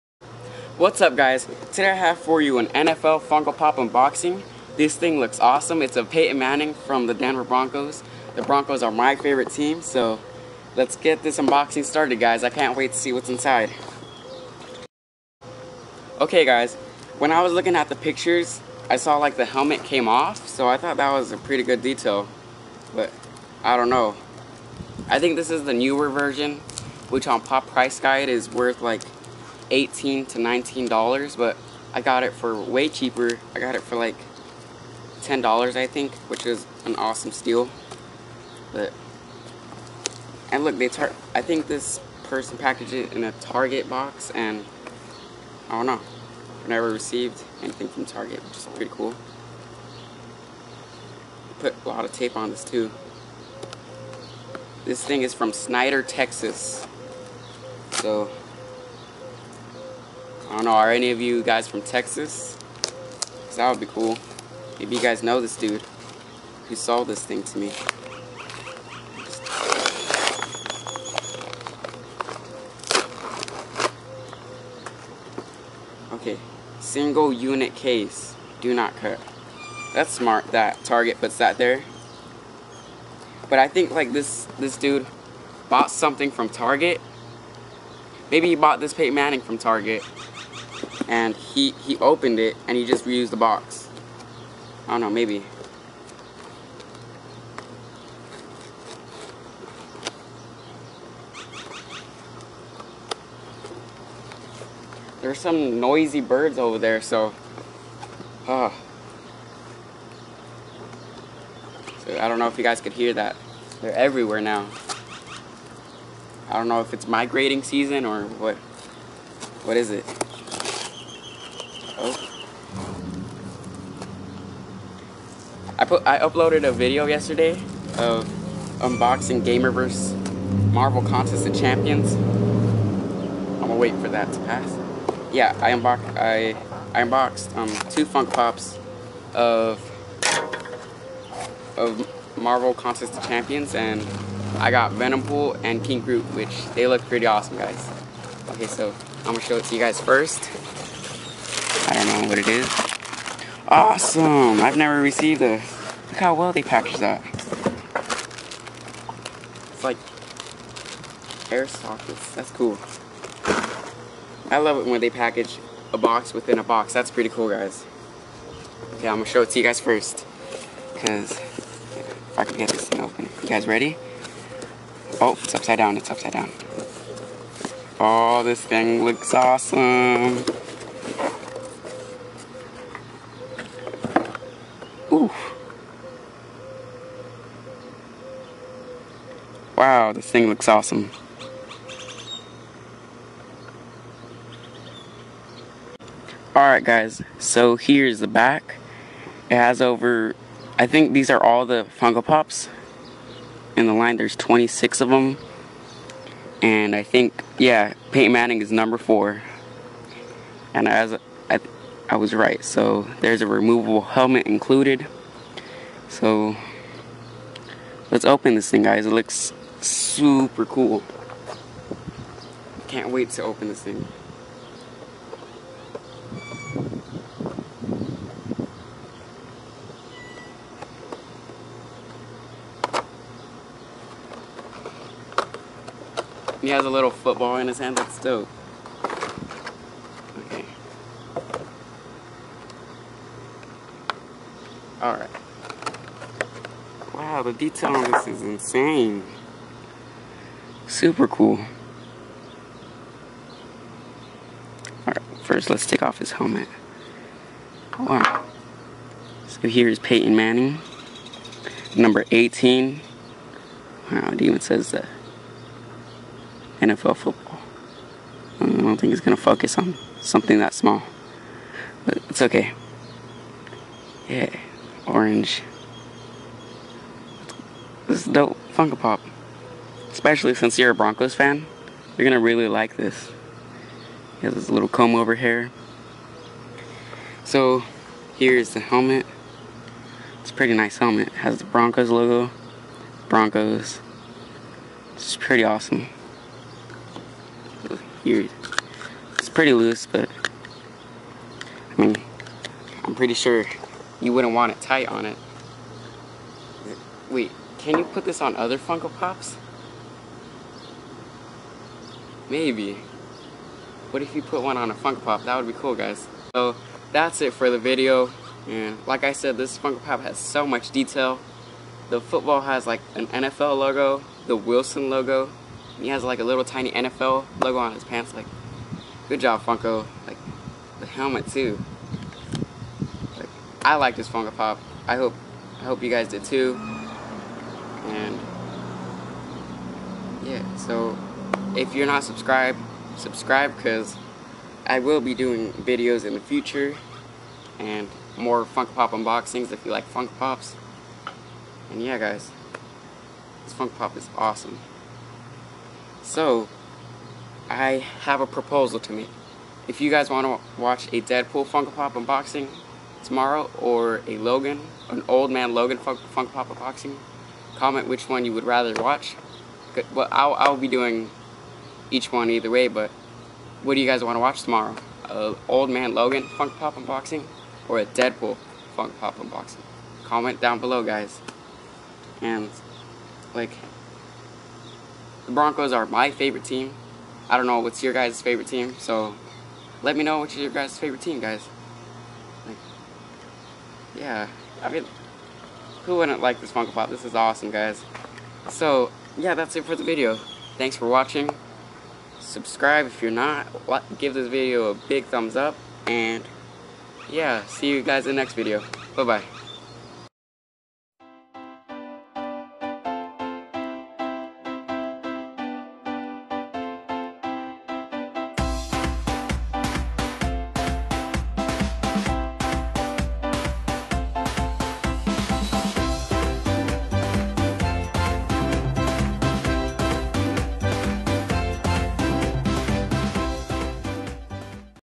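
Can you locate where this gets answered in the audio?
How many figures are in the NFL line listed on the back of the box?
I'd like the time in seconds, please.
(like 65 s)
204 s.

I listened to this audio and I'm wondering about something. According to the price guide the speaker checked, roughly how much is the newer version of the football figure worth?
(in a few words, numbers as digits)
18 to 19 dollars.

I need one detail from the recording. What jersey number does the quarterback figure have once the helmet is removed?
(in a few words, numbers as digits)
18.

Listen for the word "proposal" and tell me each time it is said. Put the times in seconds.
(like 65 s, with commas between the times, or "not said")
358 s.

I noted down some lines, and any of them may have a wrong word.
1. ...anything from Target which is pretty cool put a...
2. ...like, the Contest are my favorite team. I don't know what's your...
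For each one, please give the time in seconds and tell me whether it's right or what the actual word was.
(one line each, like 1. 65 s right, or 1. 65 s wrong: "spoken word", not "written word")
1. 47 s right
2. 383 s wrong: "Broncos", not "Contest".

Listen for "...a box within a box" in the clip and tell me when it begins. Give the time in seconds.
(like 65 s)
165 s.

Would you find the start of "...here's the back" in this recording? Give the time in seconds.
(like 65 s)
197 s.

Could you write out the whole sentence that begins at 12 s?
I can't wait to see what's inside.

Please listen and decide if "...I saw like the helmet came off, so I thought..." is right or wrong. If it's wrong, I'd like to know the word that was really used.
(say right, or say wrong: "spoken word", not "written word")
right.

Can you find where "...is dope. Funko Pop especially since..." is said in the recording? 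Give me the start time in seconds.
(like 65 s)
278 s.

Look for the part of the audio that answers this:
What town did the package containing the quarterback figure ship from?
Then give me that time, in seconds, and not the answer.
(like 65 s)
55 s.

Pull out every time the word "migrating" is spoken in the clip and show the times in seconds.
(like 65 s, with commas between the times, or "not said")
117 s.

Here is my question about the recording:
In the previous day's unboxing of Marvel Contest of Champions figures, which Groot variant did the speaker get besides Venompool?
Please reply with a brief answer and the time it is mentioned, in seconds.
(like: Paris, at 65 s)
King Groot, at 145 s.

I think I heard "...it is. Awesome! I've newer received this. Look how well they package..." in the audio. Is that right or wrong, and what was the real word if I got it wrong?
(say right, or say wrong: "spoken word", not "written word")
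wrong: "never", not "newer".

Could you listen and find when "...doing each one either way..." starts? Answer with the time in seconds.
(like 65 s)
370 s.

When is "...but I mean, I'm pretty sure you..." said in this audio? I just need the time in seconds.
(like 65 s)
300 s.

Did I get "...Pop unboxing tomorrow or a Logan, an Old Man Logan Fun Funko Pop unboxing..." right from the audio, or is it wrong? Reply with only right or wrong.
right.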